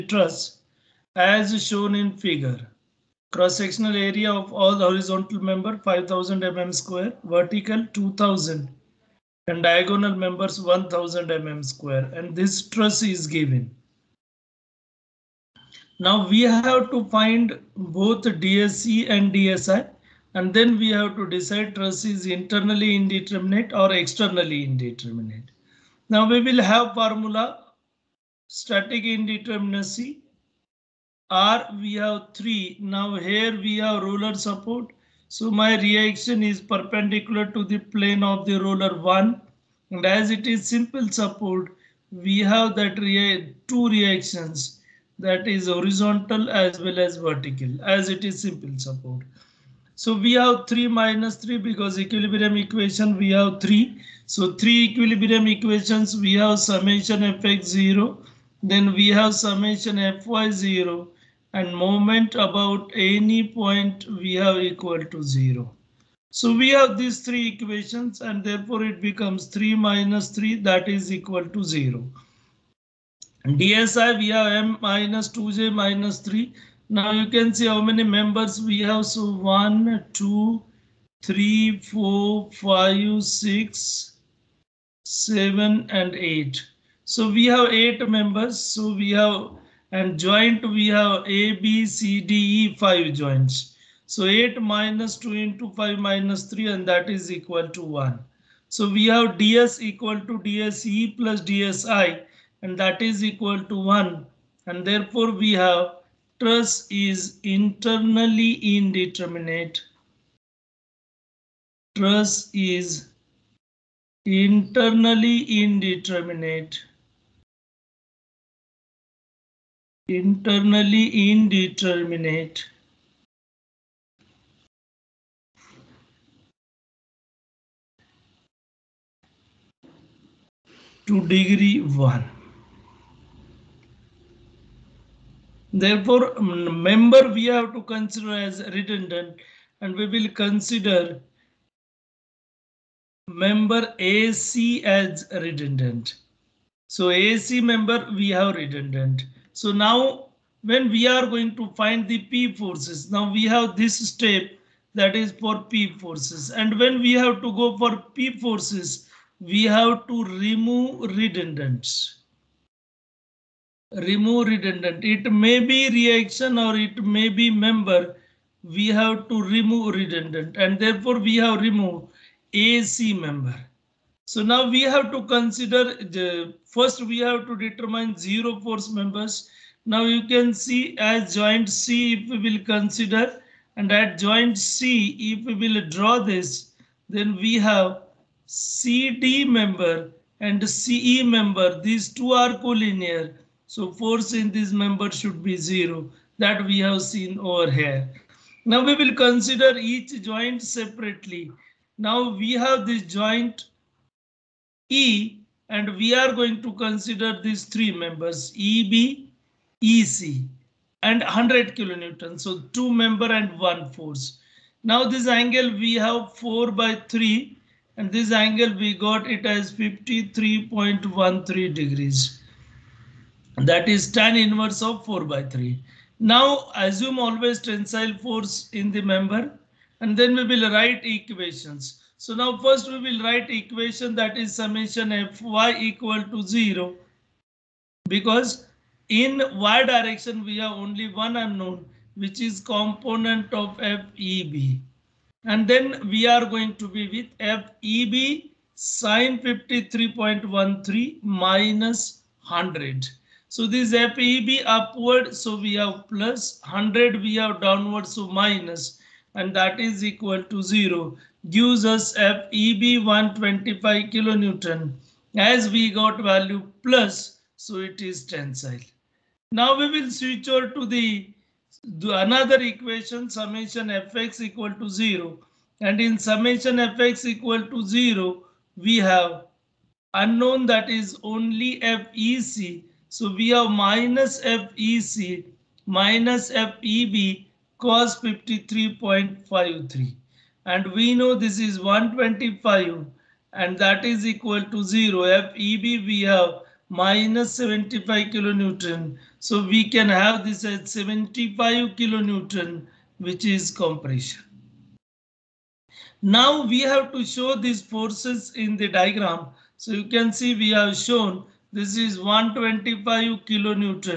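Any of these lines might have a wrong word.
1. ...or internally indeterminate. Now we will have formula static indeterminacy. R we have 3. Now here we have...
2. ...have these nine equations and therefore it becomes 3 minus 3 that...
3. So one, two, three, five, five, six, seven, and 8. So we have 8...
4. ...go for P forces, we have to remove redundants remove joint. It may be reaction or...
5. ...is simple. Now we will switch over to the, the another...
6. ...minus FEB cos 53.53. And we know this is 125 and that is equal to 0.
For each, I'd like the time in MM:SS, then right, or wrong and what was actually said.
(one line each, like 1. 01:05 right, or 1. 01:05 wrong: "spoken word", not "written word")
1. 00:23 wrong: "externally", not "internally"
2. 01:06 wrong: "three", not "nine"
3. 01:19 wrong: "four", not "five"
4. 02:37 wrong: "redundant", not "joint"
5. 04:27 wrong: "tensile", not "simple"
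6. 04:45 right.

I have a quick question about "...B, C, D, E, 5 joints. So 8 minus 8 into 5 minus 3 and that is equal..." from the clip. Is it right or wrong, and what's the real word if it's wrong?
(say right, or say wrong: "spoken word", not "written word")
wrong: "2", not "8".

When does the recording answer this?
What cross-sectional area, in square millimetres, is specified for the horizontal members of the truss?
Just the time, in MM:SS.
00:05.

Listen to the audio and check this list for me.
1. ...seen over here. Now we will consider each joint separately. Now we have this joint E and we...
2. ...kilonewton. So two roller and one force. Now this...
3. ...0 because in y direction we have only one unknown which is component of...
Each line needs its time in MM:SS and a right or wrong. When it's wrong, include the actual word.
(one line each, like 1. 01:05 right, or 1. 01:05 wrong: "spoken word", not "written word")
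1. 03:17 right
2. 03:31 wrong: "member", not "roller"
3. 03:56 right.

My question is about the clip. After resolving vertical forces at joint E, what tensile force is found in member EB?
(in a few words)
125 kilonewton.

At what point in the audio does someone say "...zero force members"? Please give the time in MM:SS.
02:58.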